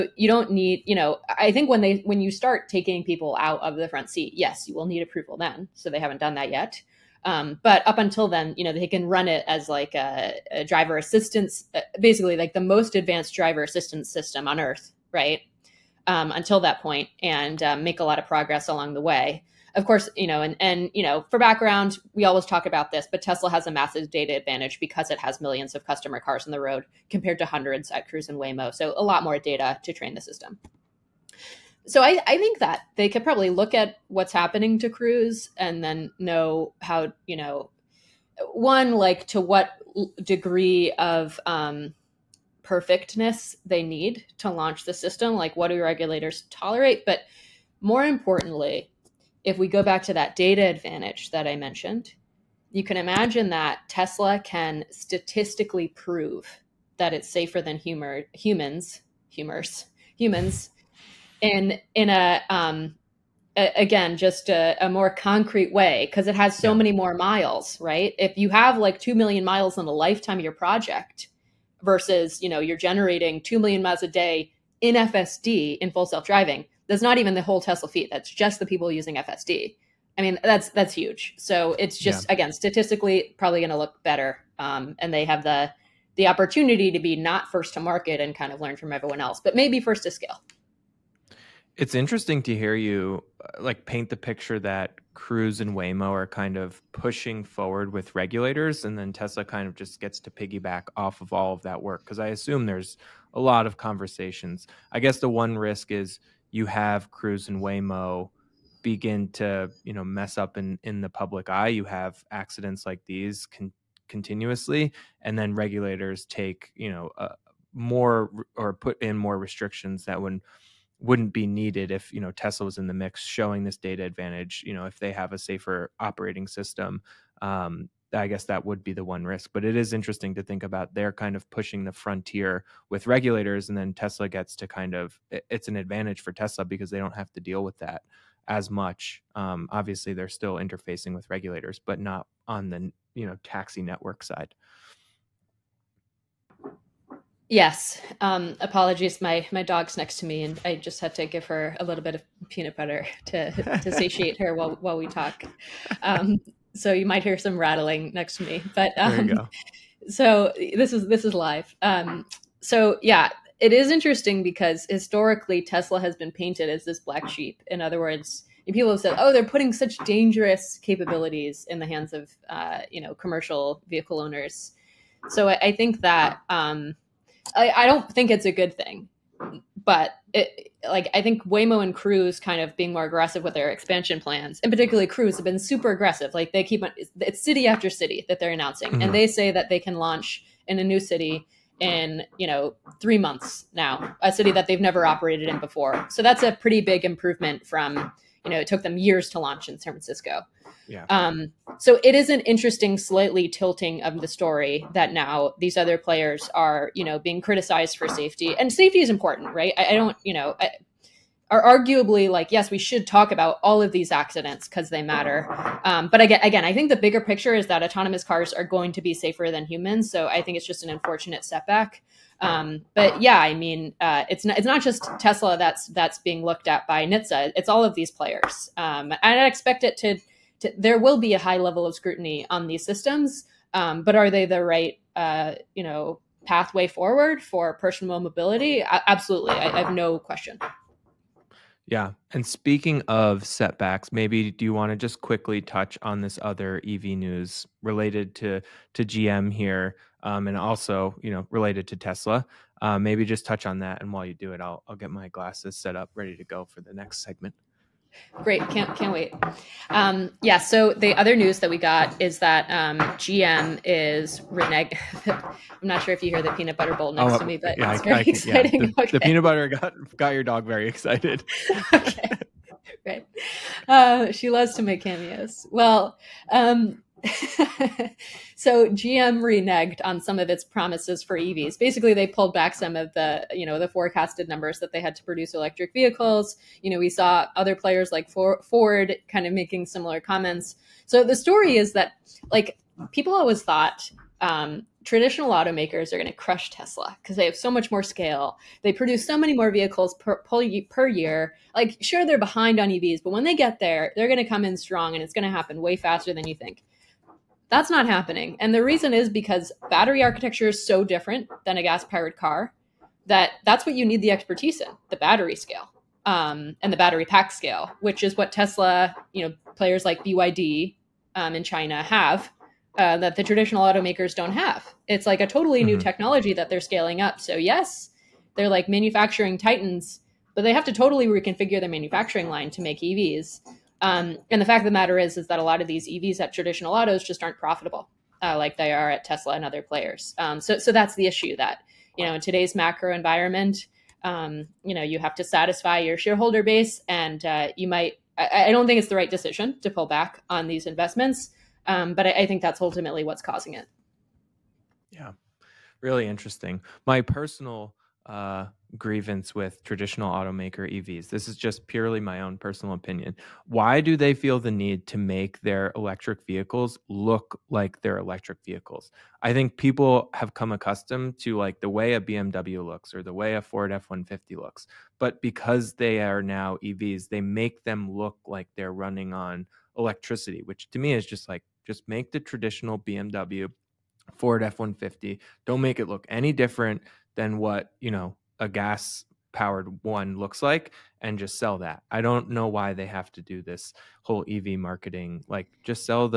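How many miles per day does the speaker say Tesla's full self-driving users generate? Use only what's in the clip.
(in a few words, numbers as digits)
2 million.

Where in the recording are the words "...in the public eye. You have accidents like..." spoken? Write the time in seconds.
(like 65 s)
110 s.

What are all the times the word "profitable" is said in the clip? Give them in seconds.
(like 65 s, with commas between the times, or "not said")
337 s.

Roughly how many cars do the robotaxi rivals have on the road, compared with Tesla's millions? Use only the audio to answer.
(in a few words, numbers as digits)
hundreds.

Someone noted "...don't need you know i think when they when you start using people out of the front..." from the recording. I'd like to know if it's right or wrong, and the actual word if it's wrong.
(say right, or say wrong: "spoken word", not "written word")
wrong: "taking", not "using".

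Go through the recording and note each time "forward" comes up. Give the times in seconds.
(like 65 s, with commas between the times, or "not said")
97 s, 236 s.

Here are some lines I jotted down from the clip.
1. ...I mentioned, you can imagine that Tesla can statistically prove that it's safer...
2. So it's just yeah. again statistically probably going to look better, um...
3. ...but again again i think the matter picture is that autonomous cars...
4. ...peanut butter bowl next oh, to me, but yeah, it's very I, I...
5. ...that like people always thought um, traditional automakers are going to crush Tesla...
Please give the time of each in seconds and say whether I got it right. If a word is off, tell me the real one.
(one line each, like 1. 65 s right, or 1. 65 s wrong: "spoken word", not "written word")
1. 51 s right
2. 81 s right
3. 216 s wrong: "bigger", not "matter"
4. 266 s right
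5. 291 s right.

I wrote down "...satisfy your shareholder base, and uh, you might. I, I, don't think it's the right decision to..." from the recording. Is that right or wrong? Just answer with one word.
right.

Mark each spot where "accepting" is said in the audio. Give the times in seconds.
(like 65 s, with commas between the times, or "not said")
not said.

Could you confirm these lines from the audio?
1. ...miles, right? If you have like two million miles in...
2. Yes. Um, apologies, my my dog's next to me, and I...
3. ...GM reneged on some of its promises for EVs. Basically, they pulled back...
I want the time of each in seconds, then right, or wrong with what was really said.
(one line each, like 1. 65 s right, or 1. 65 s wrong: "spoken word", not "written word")
1. 67 s right
2. 147 s right
3. 278 s right.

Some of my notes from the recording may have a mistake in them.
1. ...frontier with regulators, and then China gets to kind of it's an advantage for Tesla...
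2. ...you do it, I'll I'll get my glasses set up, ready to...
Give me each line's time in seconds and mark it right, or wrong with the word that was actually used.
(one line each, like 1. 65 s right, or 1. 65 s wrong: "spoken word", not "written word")
1. 131 s wrong: "Tesla", not "China"
2. 254 s right.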